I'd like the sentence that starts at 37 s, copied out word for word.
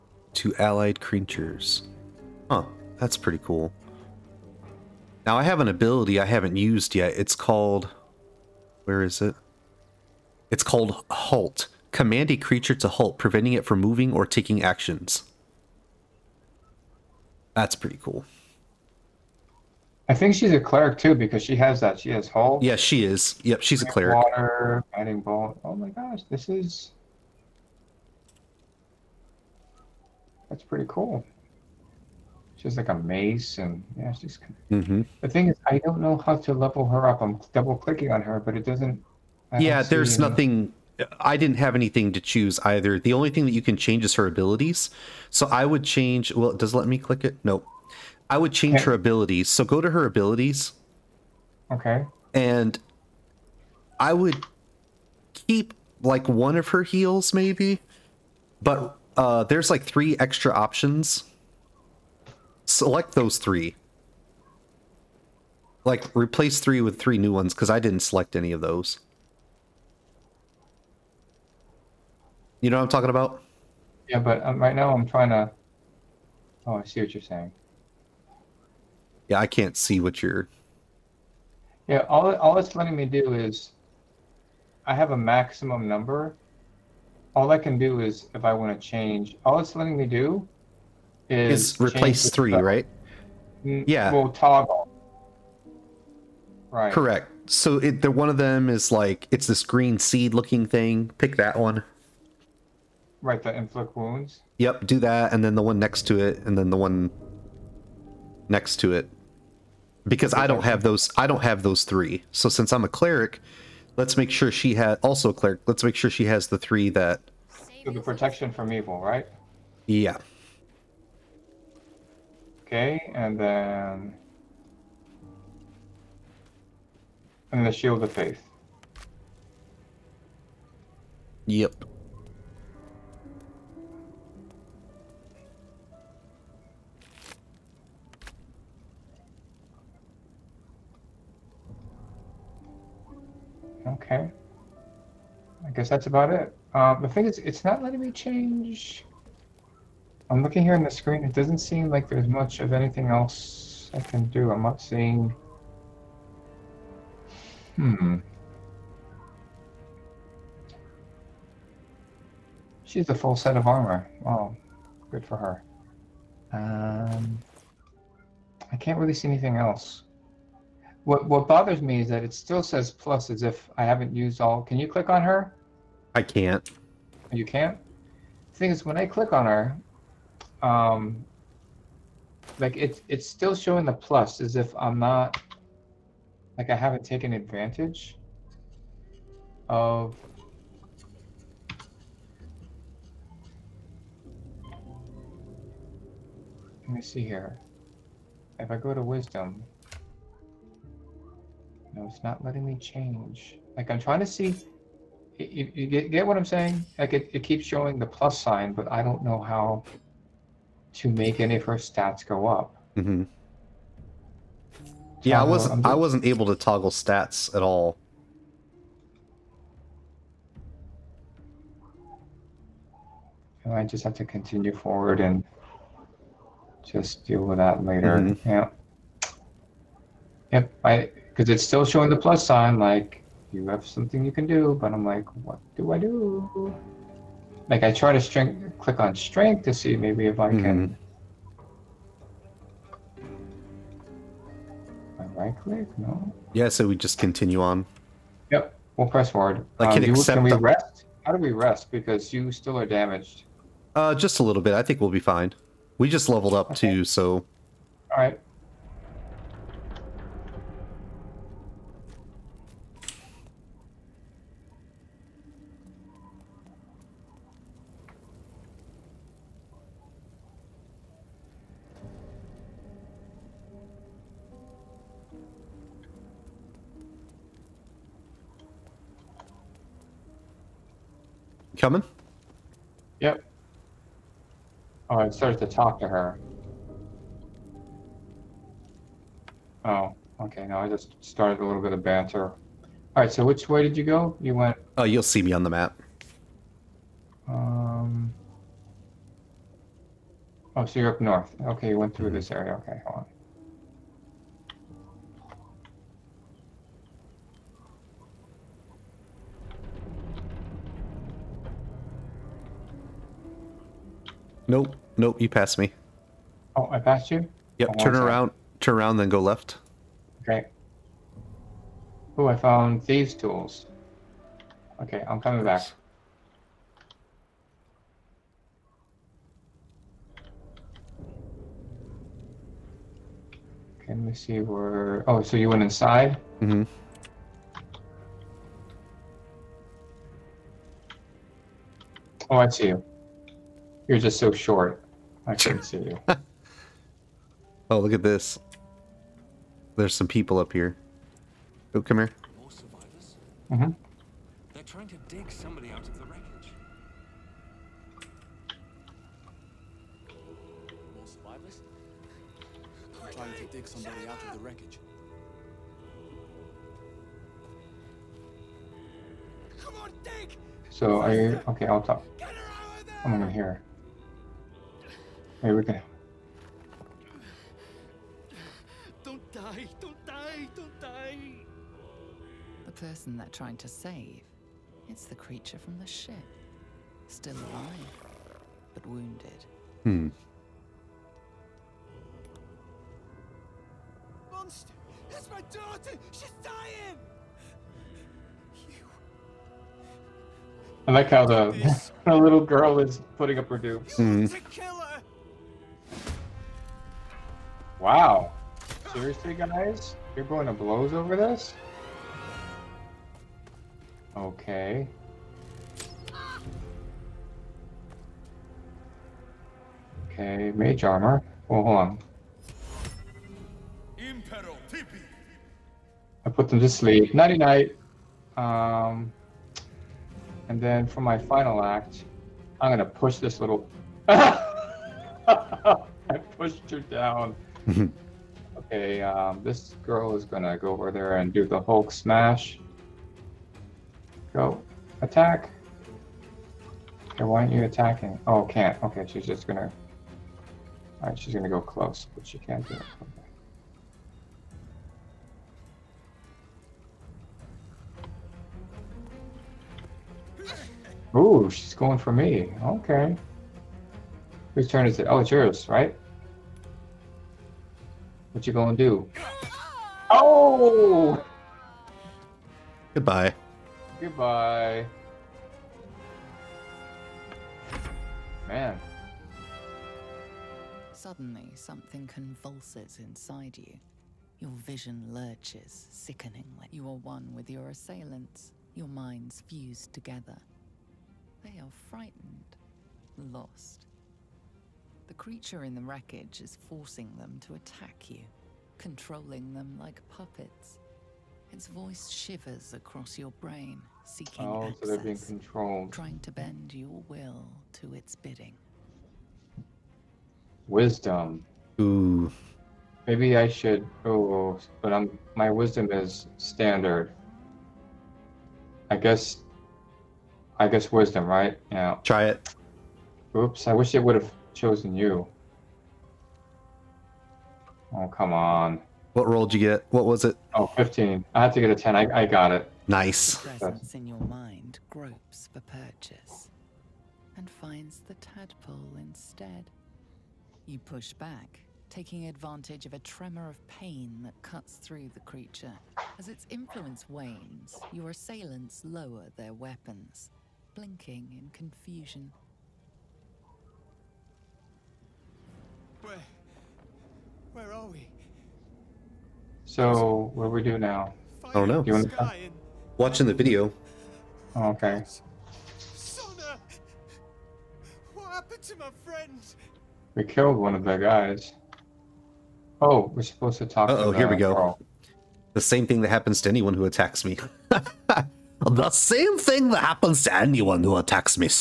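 I'm double clicking on her, but it doesn't.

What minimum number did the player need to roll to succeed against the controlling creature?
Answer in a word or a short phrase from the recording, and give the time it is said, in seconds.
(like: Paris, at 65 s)
10, at 531 s.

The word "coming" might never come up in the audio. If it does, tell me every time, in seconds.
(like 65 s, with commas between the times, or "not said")
281 s, 325 s.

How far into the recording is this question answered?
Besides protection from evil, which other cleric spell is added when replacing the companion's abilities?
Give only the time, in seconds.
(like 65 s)
127 s.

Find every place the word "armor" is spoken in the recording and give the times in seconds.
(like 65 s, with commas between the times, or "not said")
163 s, 421 s.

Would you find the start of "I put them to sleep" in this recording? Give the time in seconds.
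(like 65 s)
426 s.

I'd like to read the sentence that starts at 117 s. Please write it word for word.
So the protection from evil, right?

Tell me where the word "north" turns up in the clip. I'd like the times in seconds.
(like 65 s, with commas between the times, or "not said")
301 s.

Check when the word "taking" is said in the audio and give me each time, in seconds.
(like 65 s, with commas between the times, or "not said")
14 s, 542 s.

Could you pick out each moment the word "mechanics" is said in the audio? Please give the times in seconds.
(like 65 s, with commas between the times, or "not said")
not said.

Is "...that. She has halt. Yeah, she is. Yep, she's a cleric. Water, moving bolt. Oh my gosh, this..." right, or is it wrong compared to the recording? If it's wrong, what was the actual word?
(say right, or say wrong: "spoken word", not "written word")
wrong: "guiding", not "moving".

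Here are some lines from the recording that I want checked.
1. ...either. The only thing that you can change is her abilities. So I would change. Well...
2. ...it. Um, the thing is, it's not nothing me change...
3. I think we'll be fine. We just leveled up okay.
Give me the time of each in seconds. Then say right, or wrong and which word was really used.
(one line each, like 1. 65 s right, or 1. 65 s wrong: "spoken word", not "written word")
1. 42 s right
2. 146 s wrong: "letting", not "nothing"
3. 254 s right.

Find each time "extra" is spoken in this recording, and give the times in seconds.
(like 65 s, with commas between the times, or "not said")
60 s.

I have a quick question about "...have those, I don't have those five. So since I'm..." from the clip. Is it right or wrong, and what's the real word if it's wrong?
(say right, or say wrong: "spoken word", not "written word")
wrong: "three", not "five".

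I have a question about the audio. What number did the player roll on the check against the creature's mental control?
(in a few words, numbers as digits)
15.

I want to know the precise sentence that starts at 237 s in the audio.
Like I try to string, click on strength to see maybe if I can.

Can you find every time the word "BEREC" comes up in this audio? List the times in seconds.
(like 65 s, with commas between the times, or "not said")
not said.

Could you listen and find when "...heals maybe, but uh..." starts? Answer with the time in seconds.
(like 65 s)
56 s.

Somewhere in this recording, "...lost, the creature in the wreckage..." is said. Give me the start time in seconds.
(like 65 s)
493 s.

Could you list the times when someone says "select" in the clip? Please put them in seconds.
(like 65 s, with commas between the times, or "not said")
62 s, 68 s.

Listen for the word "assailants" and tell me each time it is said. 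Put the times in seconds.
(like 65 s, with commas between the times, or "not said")
487 s, 548 s.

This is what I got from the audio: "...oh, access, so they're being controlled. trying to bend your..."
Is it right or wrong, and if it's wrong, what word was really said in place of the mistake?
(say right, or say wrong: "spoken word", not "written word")
right.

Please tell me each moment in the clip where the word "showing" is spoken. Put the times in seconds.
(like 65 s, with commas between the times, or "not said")
183 s, 207 s, 231 s.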